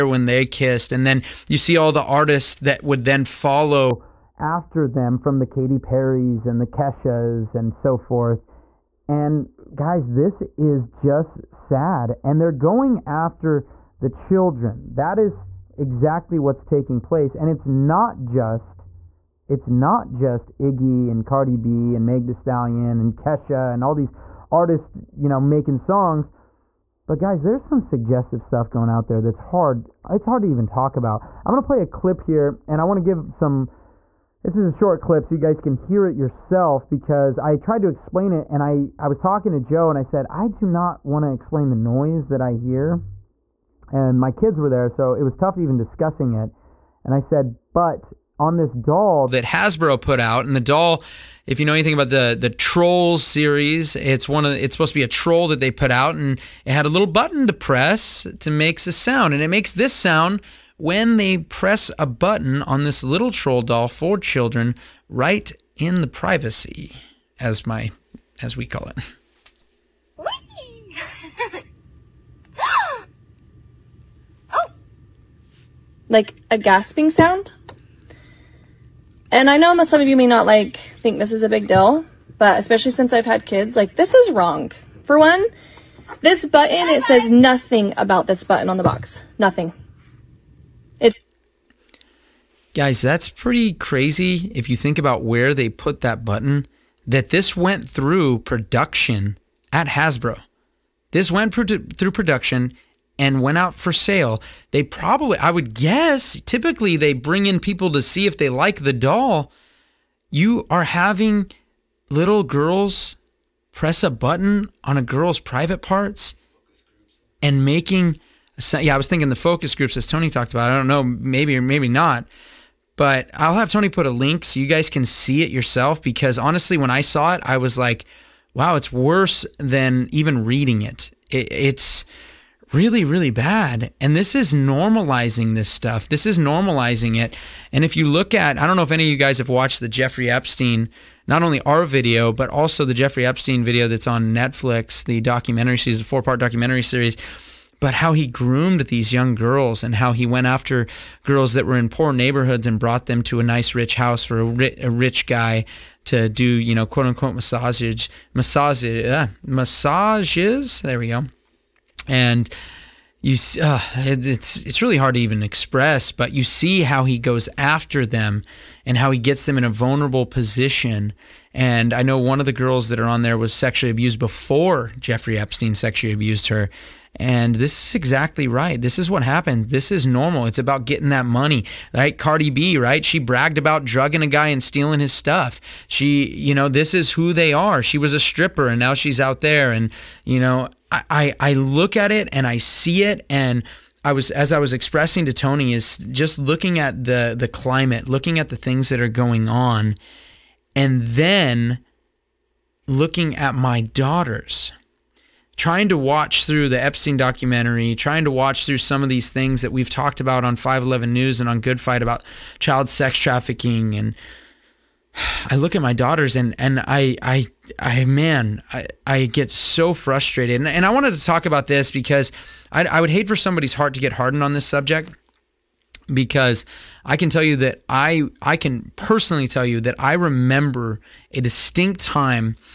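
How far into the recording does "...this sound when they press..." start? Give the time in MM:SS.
00:59.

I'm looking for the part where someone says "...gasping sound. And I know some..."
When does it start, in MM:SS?
01:16.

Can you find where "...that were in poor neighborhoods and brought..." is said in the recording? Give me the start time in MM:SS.
02:31.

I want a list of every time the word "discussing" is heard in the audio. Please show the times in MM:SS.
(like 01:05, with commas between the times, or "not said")
00:45.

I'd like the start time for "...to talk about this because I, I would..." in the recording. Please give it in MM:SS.
03:41.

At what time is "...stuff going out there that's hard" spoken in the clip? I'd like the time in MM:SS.
00:28.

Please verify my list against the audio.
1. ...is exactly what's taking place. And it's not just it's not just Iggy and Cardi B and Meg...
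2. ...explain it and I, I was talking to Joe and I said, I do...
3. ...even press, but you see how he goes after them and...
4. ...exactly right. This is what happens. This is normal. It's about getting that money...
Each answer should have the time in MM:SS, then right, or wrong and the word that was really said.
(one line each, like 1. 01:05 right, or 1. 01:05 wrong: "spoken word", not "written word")
1. 00:15 right
2. 00:37 right
3. 02:45 wrong: "express", not "press"
4. 02:57 right.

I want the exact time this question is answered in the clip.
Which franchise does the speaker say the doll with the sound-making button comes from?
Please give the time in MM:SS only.
00:52.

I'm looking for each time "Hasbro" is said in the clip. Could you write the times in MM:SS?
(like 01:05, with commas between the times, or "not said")
00:49, 01:39.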